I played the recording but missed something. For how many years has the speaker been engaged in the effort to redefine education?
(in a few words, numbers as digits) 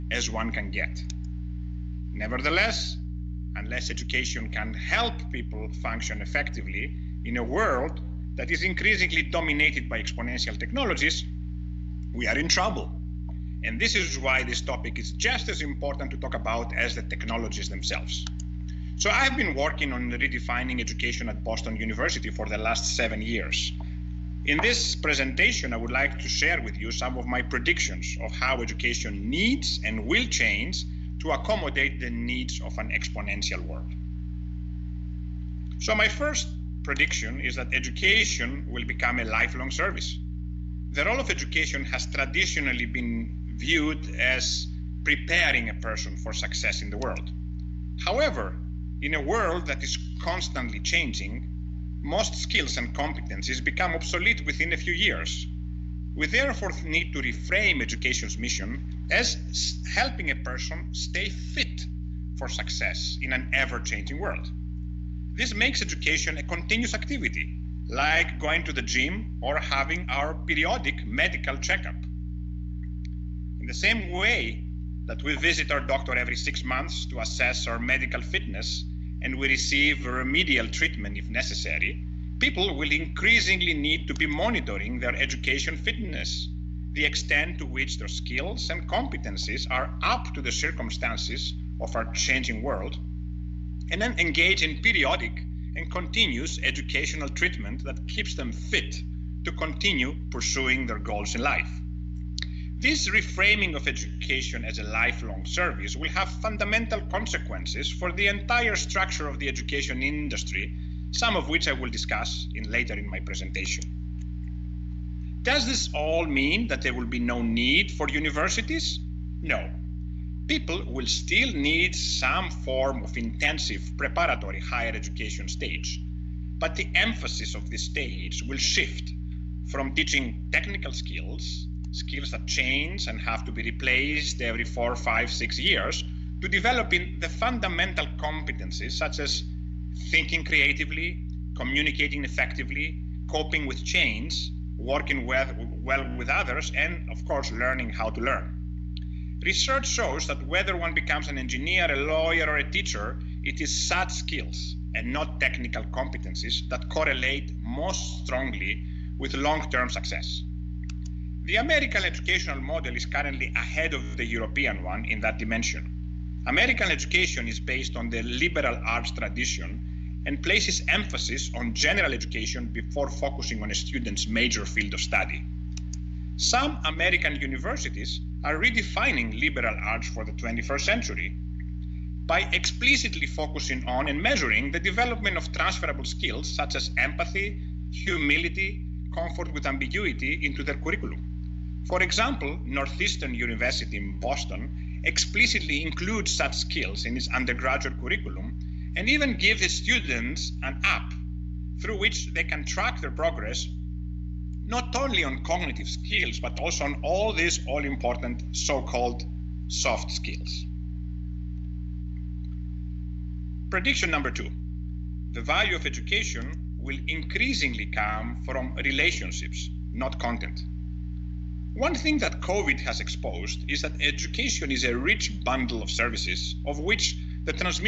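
7.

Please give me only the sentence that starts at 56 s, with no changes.
We therefore need to reframe education's mission as helping a person stay fit for success in an ever changing world.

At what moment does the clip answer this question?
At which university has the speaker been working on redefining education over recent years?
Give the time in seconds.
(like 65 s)
21 s.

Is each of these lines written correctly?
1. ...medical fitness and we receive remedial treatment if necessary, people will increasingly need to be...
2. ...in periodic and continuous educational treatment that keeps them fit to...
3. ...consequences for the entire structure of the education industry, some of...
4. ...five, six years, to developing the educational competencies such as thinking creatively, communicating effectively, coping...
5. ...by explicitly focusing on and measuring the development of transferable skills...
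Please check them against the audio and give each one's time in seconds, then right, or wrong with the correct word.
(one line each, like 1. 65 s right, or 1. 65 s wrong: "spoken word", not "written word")
1. 77 s right
2. 94 s right
3. 107 s right
4. 134 s wrong: "fundamental", not "educational"
5. 182 s right.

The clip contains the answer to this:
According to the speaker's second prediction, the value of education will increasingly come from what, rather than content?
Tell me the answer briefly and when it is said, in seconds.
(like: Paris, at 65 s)
Relationships, at 218 s.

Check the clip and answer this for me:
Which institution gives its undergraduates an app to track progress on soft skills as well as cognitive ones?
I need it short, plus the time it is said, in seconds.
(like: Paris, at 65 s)
Northeastern University, at 192 s.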